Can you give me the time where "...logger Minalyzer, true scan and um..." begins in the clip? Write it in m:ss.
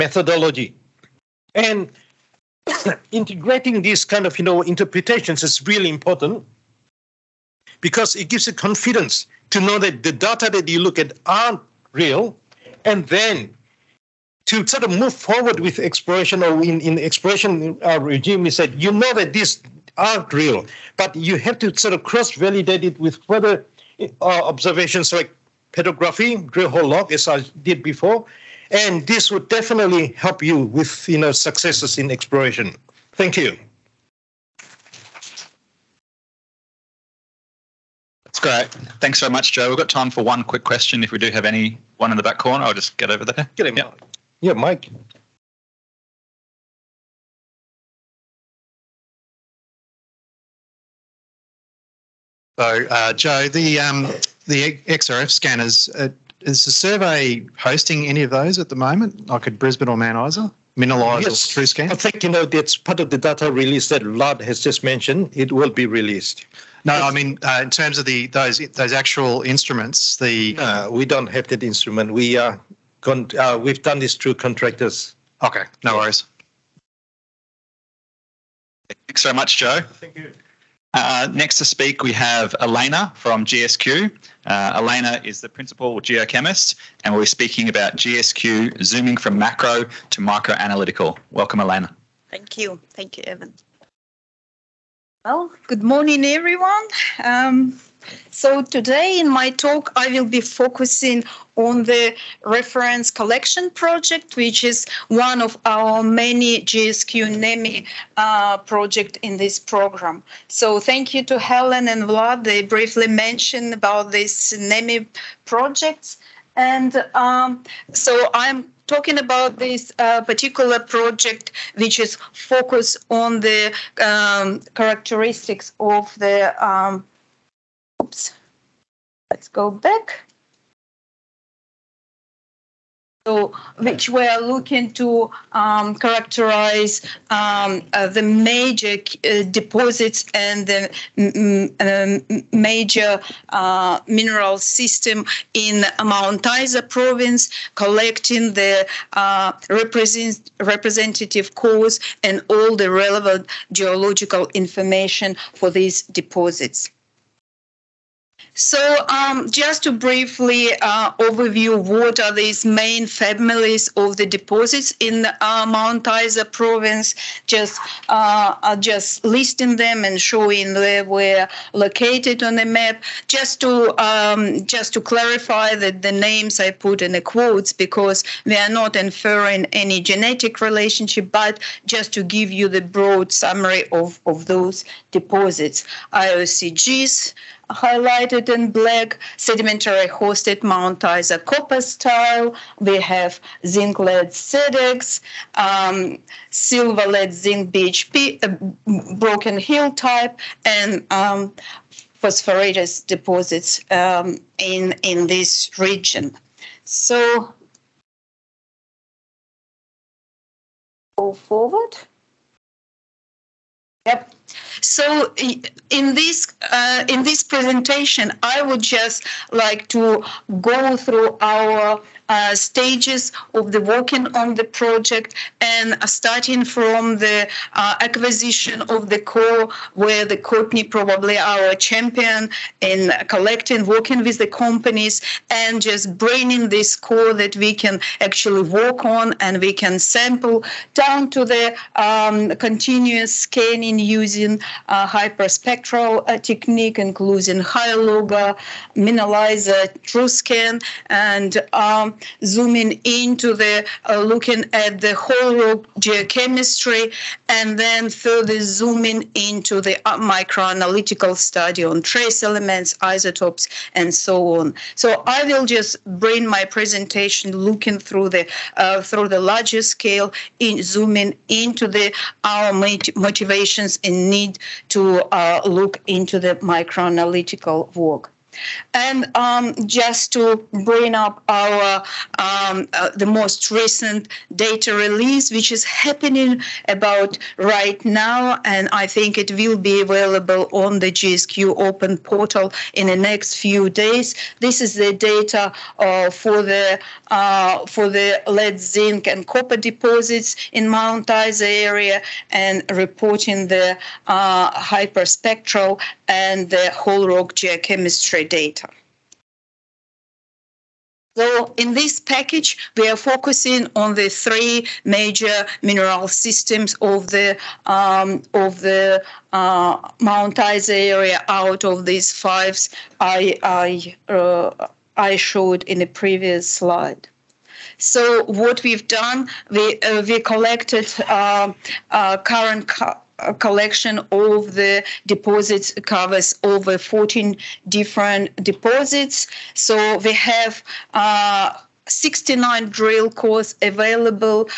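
4:07.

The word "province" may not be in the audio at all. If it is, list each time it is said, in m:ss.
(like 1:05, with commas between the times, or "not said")
2:26, 2:46.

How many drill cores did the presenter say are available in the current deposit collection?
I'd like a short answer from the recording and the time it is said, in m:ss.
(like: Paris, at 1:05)
69, at 5:42.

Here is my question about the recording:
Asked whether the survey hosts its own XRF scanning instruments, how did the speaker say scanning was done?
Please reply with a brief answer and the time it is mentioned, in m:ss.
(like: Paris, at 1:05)
Through contractors, at 1:14.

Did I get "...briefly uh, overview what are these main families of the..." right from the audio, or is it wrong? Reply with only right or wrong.
right.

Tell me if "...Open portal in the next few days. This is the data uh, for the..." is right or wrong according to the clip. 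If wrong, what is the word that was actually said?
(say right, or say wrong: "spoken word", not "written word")
right.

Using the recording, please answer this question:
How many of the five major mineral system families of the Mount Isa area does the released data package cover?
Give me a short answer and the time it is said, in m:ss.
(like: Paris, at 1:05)
3, at 5:14.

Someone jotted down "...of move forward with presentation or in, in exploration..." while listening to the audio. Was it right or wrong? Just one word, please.
wrong.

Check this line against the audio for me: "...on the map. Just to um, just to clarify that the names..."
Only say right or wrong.
right.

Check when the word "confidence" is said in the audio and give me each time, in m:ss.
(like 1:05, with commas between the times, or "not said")
0:08.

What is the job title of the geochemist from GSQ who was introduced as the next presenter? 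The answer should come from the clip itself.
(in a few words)
Principal geochemist.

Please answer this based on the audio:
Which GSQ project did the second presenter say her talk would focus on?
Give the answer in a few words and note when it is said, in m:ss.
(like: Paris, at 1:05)
Reference collection project, at 1:42.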